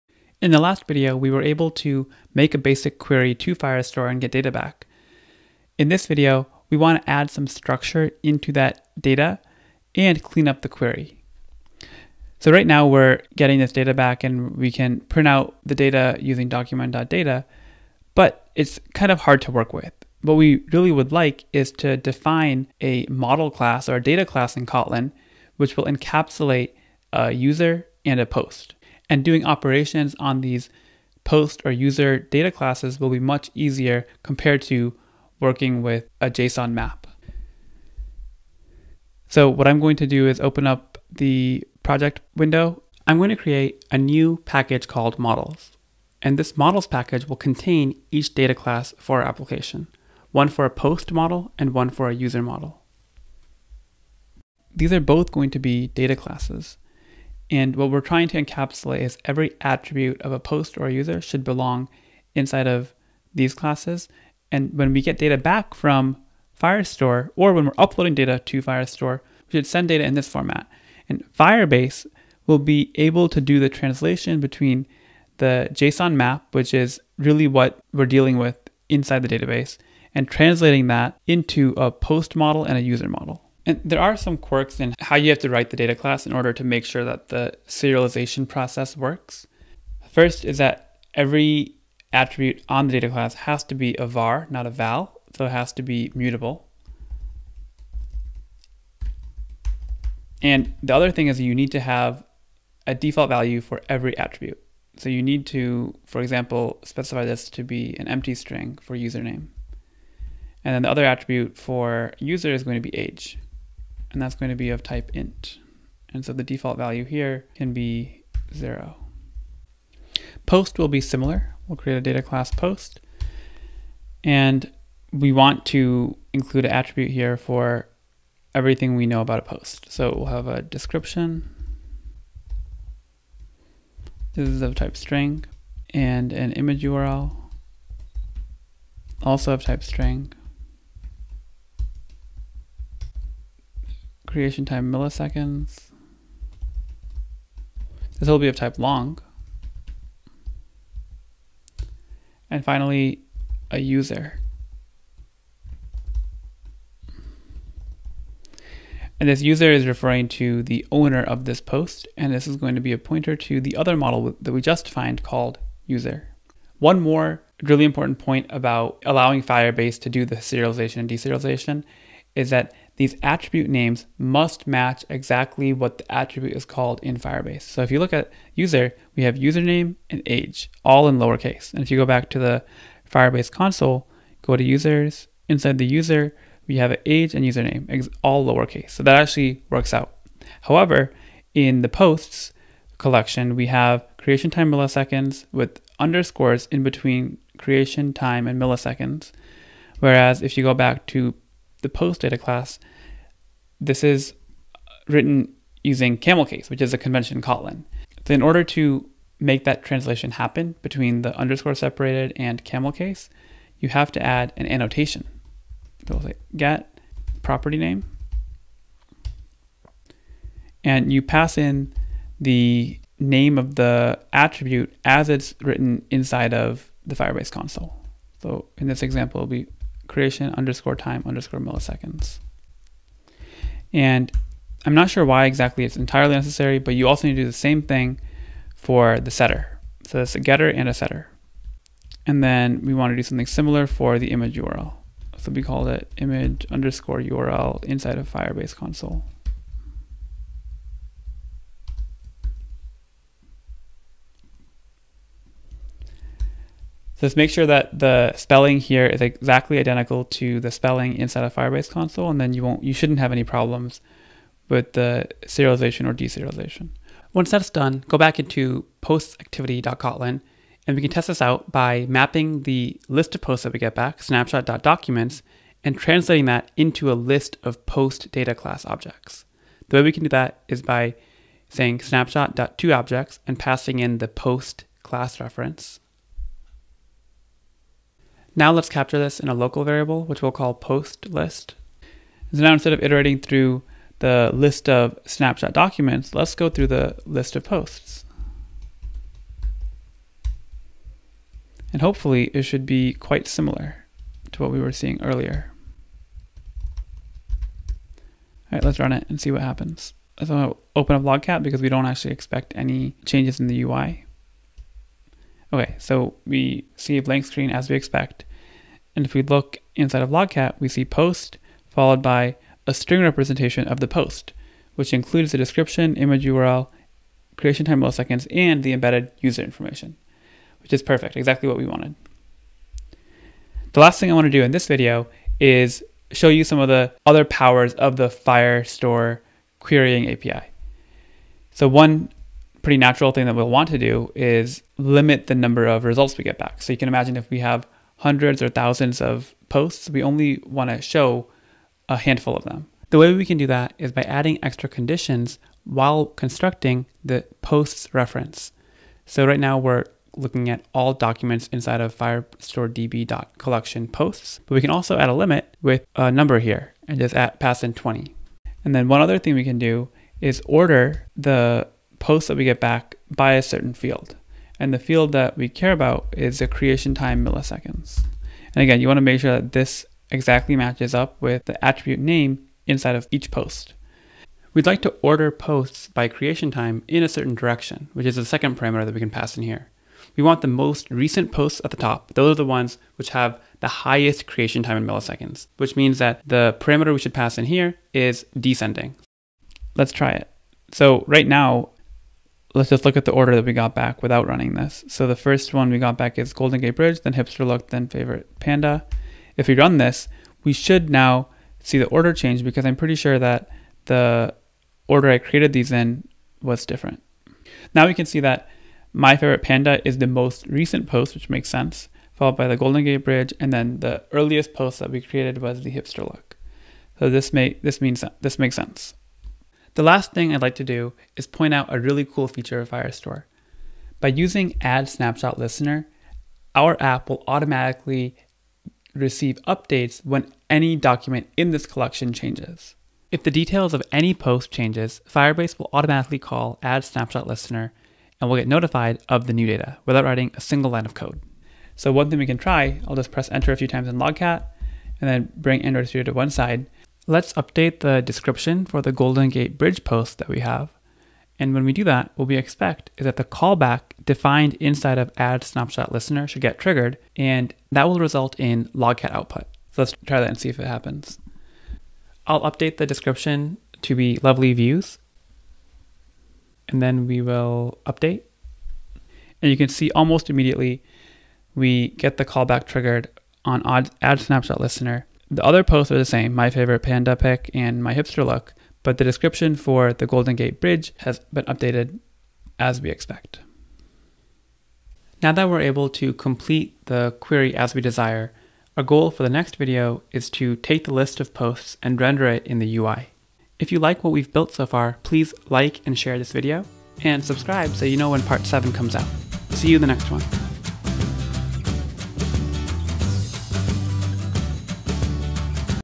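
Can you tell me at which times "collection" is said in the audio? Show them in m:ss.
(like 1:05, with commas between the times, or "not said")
3:12, 6:03, 7:21.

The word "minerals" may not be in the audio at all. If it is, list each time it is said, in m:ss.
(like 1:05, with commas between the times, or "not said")
not said.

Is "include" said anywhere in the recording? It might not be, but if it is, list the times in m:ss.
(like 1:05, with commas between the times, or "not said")
2:06, 5:25.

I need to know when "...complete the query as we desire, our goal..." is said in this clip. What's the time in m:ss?
8:16.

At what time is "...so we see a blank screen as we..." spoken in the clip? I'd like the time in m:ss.
5:15.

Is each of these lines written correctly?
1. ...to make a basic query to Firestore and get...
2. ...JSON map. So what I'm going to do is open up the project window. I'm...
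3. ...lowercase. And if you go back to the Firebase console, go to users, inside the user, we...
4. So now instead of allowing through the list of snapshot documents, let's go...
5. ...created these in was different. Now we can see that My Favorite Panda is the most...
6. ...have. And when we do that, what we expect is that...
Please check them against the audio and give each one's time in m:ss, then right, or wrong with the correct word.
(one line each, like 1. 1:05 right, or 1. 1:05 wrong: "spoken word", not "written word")
1. 0:01 right
2. 0:36 right
3. 3:01 right
4. 4:52 wrong: "iterating", not "allowing"
5. 6:55 right
6. 7:40 right.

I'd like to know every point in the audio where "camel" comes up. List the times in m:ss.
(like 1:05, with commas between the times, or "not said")
3:26, 3:32.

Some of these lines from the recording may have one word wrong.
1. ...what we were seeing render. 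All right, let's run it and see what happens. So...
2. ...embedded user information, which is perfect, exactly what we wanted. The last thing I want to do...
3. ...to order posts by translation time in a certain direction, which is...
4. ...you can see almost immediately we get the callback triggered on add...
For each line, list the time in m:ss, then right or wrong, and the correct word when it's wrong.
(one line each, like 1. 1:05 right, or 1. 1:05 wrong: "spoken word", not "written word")
1. 5:04 wrong: "earlier", not "render"
2. 5:28 right
3. 6:25 wrong: "creation", not "translation"
4. 7:59 right.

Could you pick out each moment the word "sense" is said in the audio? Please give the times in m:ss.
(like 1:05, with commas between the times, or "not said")
7:01, 7:08.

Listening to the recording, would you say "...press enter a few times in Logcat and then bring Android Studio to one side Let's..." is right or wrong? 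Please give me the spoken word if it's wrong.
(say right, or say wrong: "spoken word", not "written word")
right.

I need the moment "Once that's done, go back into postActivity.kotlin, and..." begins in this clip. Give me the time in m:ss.
4:27.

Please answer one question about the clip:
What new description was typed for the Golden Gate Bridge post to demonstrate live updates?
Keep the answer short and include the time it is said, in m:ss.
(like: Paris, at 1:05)
lovely views, at 7:54.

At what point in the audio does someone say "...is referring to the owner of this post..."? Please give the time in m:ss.
2:39.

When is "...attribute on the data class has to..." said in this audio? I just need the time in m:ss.
1:32.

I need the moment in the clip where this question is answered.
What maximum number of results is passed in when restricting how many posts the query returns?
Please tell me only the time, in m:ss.
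6:07.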